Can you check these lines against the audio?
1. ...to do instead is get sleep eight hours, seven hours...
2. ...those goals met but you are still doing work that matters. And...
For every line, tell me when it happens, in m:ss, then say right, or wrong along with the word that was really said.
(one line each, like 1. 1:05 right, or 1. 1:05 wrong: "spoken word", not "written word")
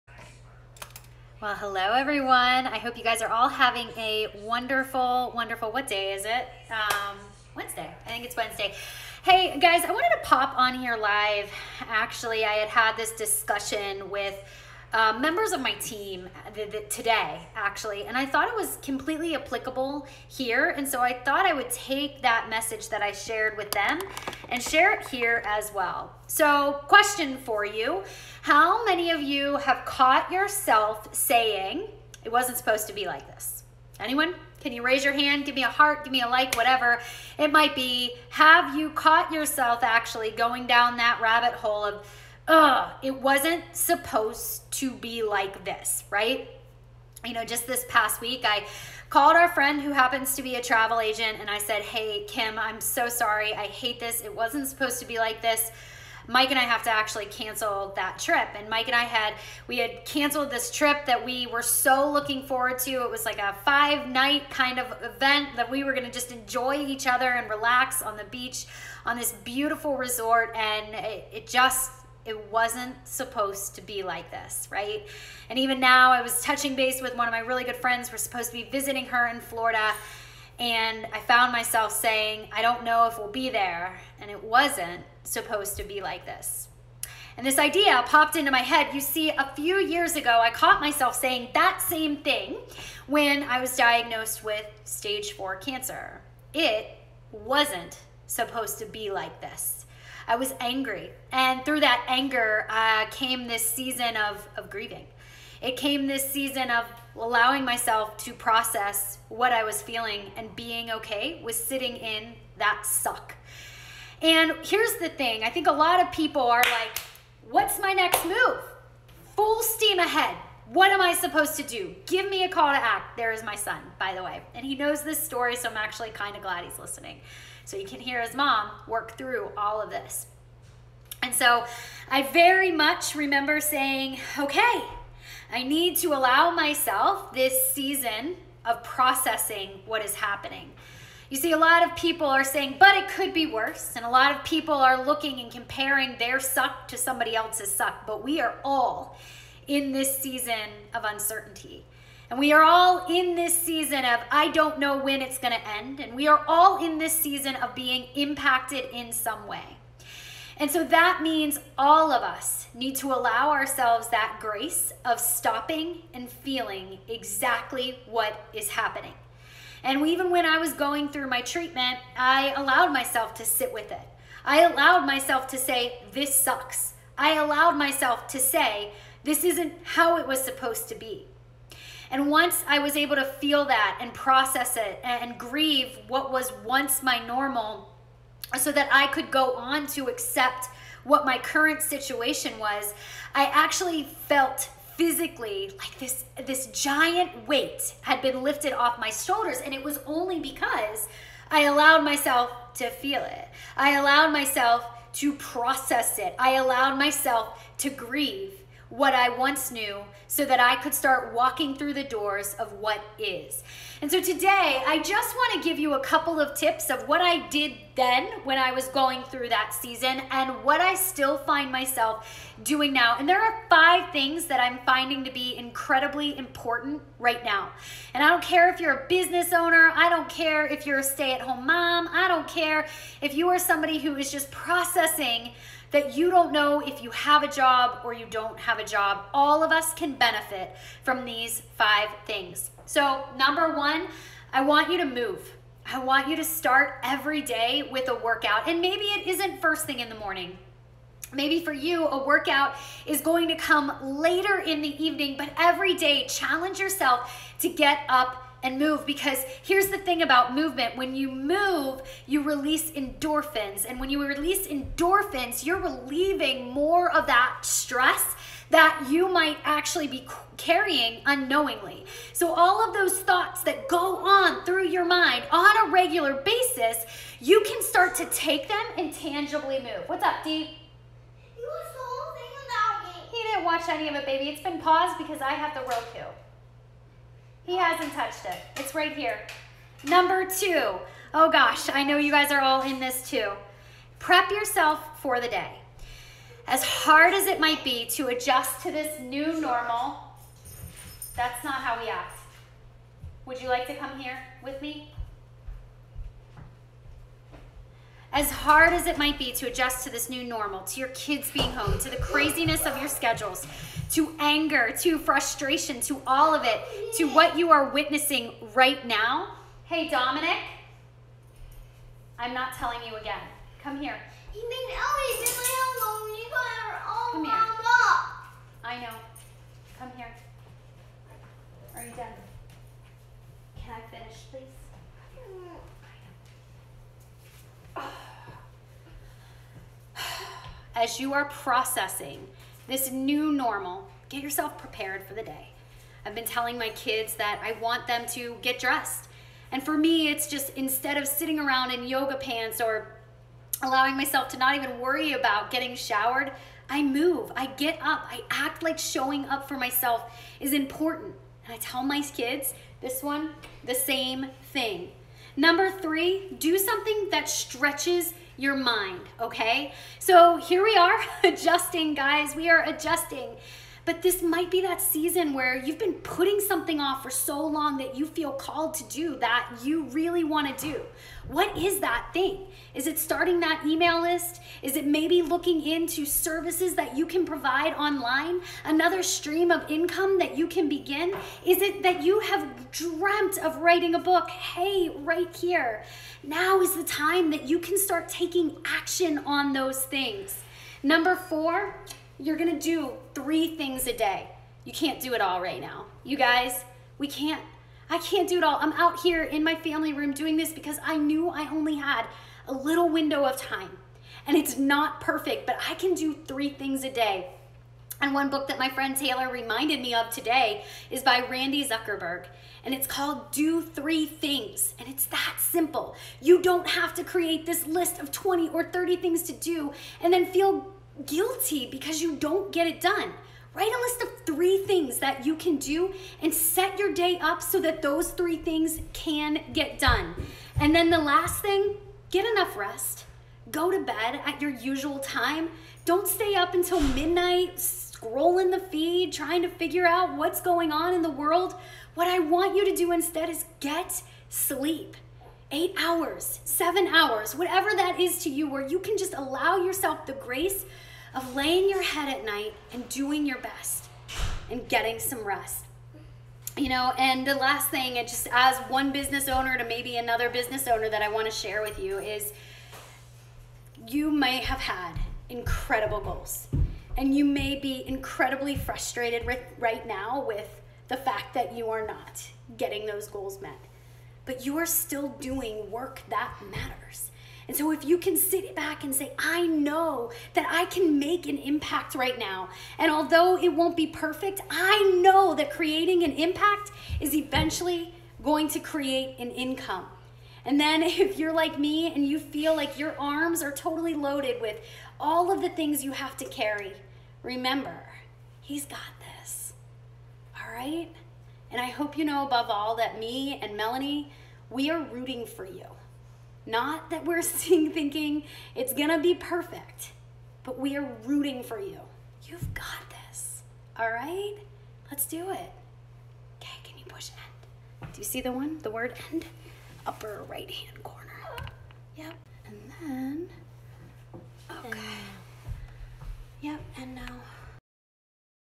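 1. 7:32 right
2. 8:03 right.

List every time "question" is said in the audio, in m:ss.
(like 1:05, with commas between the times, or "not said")
0:26.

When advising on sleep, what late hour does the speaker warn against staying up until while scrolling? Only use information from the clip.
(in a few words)
midnight.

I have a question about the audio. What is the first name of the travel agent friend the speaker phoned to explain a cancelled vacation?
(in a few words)
Kim.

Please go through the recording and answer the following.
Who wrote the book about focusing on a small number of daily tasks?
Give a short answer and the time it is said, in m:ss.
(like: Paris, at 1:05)
Randi Zuckerberg, at 7:01.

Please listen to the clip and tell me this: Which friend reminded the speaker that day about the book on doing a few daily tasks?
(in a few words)
Taylor.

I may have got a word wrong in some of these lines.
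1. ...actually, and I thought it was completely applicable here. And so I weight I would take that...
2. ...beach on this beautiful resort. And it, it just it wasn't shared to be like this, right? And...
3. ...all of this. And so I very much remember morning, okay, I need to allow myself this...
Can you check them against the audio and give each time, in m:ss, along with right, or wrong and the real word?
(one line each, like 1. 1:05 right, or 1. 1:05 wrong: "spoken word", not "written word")
1. 0:17 wrong: "thought", not "weight"
2. 1:08 wrong: "supposed", not "shared"
3. 2:09 wrong: "saying", not "morning".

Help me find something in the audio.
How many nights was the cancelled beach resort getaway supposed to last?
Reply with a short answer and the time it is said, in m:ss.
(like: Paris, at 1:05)
5, at 1:03.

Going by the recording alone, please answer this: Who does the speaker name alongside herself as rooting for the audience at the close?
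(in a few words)
Melanie.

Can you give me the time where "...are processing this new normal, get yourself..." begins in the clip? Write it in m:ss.
5:41.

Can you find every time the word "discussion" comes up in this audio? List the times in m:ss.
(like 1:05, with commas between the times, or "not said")
0:13.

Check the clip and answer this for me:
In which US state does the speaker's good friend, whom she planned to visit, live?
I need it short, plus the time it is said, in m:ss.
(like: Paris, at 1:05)
Florida, at 1:19.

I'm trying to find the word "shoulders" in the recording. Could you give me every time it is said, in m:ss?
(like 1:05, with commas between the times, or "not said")
3:19.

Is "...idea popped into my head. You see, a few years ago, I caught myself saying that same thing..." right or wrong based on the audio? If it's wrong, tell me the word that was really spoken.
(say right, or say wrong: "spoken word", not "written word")
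right.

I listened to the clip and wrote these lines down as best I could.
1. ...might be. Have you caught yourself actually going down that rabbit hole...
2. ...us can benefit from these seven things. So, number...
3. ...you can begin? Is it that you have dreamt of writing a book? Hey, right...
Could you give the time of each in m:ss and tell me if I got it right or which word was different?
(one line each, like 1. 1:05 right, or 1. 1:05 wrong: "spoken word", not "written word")
1. 0:37 right
2. 3:59 wrong: "five", not "seven"
3. 6:30 right.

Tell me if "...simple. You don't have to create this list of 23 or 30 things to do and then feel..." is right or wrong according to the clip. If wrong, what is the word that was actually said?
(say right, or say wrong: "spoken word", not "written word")
wrong: "20", not "23".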